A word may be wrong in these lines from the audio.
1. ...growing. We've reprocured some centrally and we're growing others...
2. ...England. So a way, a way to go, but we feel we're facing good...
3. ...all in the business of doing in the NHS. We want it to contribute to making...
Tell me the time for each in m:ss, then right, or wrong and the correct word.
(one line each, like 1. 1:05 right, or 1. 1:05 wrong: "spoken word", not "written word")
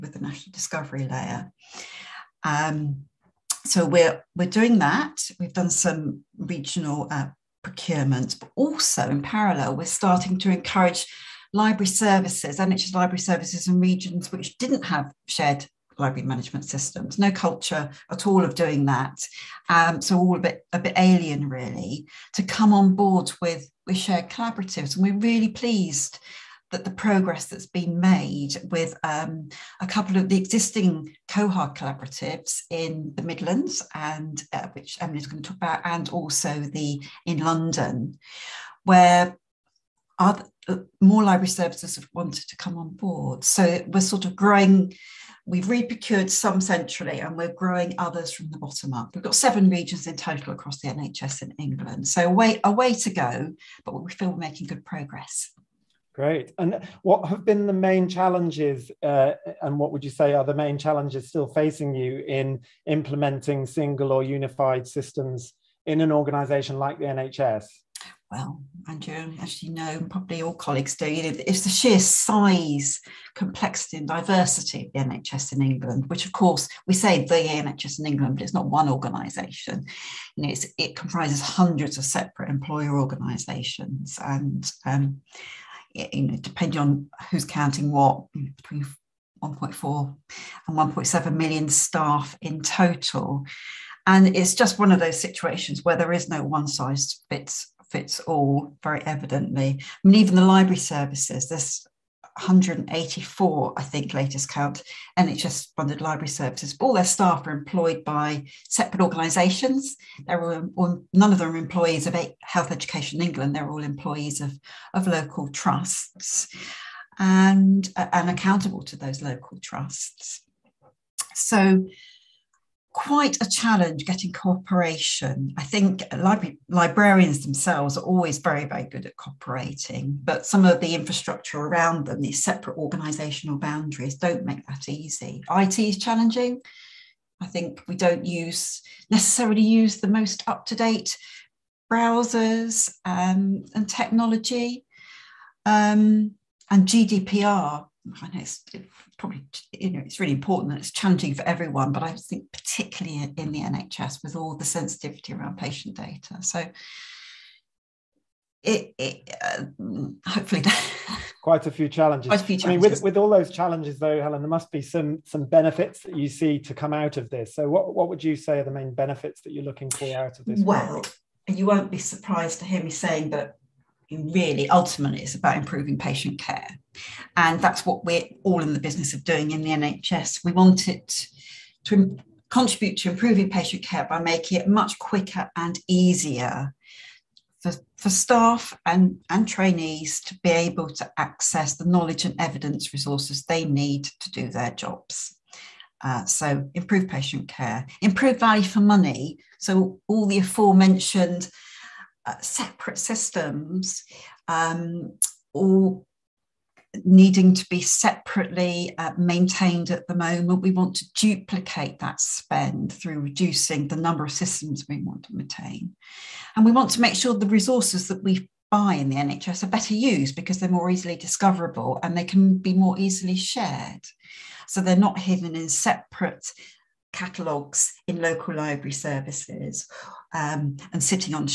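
1. 0:44 right
2. 0:51 wrong: "making", not "facing"
3. 2:58 wrong: "improving", not "making".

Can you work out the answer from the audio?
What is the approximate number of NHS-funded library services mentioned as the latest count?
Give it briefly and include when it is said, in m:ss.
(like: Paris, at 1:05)
184, at 1:42.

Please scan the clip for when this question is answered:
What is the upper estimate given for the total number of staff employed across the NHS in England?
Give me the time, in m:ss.
1:30.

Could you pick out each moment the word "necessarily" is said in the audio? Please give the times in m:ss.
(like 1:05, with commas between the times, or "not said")
2:19.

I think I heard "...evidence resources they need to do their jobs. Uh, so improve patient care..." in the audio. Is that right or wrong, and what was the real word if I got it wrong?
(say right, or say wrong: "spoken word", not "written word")
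right.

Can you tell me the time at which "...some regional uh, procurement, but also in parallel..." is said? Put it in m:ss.
0:05.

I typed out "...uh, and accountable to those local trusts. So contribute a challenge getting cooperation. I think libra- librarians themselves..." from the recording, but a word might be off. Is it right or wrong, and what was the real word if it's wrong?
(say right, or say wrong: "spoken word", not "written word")
wrong: "quite", not "contribute".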